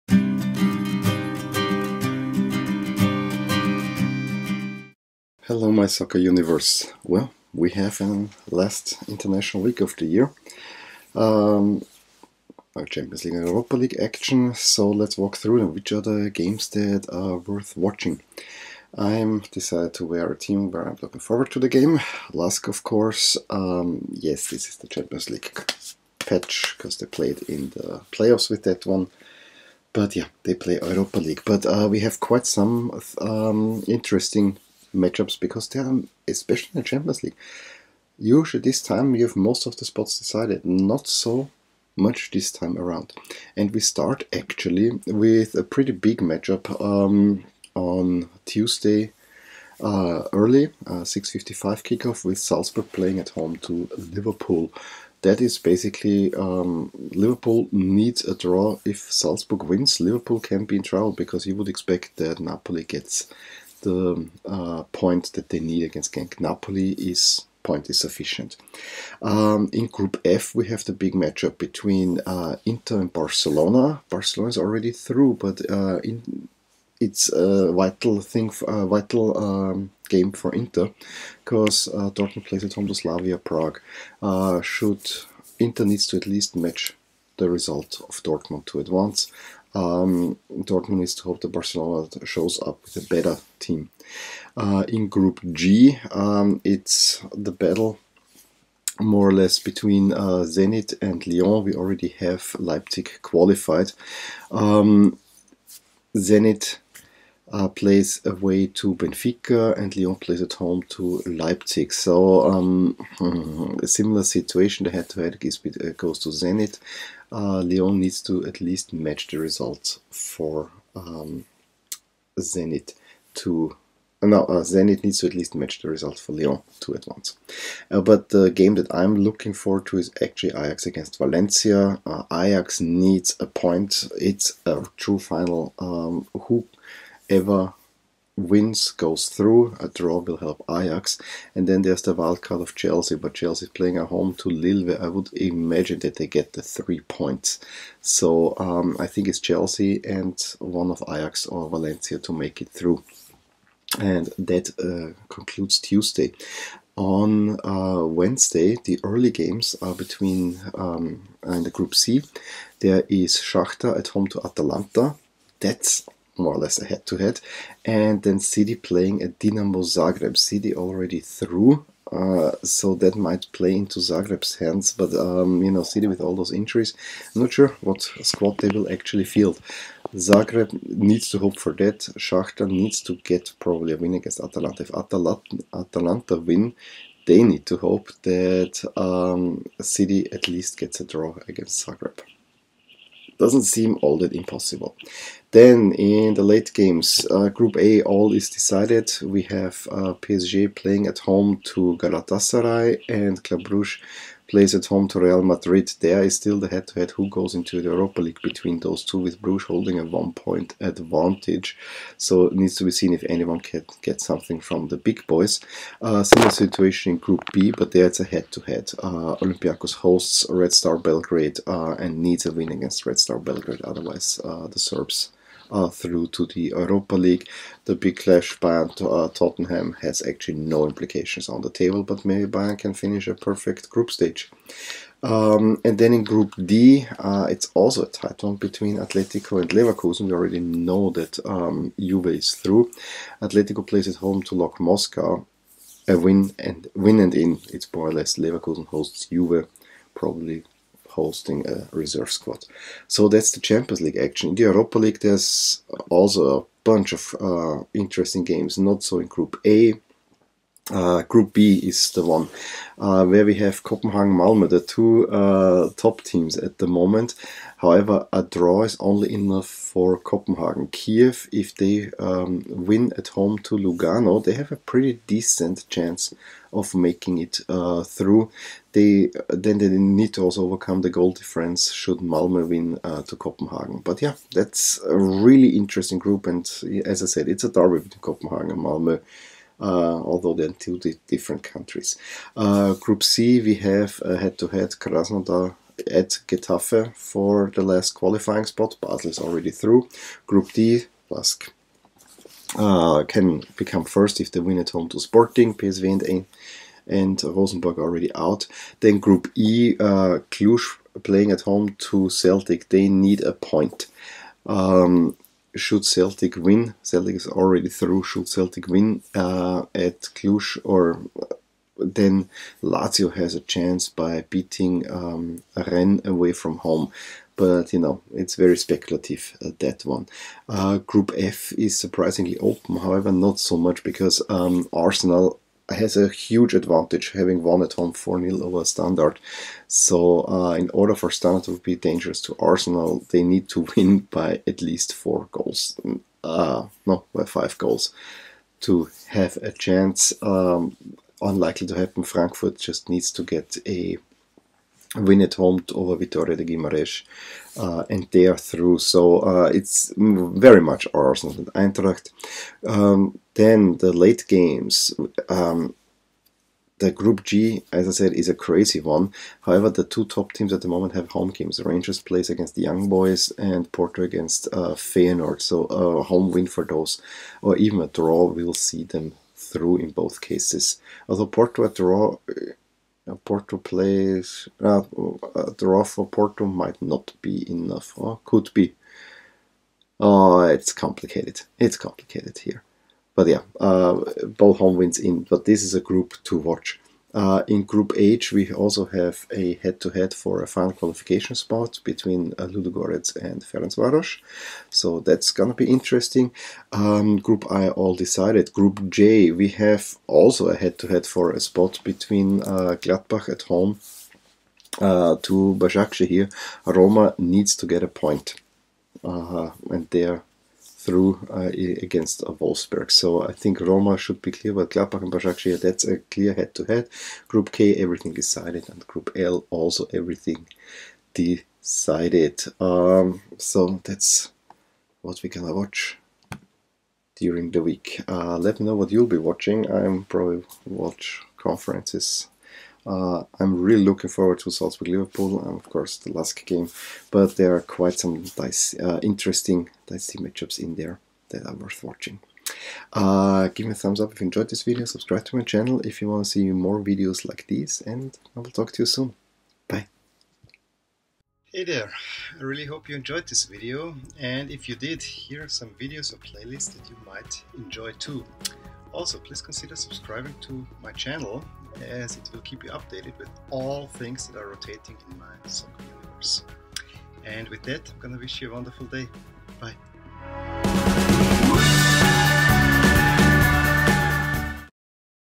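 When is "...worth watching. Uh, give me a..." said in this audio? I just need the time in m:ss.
7:31.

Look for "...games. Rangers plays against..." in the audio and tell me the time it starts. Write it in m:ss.
6:11.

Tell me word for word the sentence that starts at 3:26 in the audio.
There is still the head-to-head who goes into the Europa League between those two, with Bruges holding a one-point advantage.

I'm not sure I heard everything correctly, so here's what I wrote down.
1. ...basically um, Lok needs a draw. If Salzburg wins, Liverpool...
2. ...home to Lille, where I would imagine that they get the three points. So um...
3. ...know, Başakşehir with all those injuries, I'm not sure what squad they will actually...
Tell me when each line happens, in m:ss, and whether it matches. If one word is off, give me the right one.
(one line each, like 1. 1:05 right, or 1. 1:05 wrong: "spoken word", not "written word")
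1. 0:55 wrong: "Liverpool", not "Lok"
2. 2:24 right
3. 2:55 wrong: "City", not "Başakşehir".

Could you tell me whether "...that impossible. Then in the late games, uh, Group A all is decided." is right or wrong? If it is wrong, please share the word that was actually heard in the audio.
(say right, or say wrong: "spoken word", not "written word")
right.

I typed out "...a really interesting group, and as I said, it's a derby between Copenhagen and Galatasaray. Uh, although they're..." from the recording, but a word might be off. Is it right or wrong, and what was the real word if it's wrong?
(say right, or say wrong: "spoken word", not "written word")
wrong: "Malmö", not "Galatasaray".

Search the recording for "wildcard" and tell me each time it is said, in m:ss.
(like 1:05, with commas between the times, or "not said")
2:22.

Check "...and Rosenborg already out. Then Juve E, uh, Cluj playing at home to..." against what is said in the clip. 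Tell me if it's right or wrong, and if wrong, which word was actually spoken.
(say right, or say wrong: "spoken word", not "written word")
wrong: "Group", not "Juve".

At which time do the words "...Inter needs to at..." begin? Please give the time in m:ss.
1:25.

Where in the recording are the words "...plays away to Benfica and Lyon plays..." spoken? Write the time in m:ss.
1:47.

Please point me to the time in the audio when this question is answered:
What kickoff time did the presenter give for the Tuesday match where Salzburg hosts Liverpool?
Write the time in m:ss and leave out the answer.
0:51.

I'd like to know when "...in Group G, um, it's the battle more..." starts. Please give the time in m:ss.
1:34.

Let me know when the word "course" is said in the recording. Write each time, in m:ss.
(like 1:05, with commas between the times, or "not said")
0:22, 7:25.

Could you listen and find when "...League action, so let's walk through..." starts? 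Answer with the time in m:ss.
0:13.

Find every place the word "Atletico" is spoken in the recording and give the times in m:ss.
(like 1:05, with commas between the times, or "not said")
3:58, 4:03.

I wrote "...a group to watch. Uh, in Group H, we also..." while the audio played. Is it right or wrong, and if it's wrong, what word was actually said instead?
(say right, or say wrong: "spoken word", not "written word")
right.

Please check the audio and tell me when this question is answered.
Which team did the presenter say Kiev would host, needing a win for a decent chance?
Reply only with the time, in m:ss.
4:33.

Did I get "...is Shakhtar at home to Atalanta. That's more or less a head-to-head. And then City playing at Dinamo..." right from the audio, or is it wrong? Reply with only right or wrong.
right.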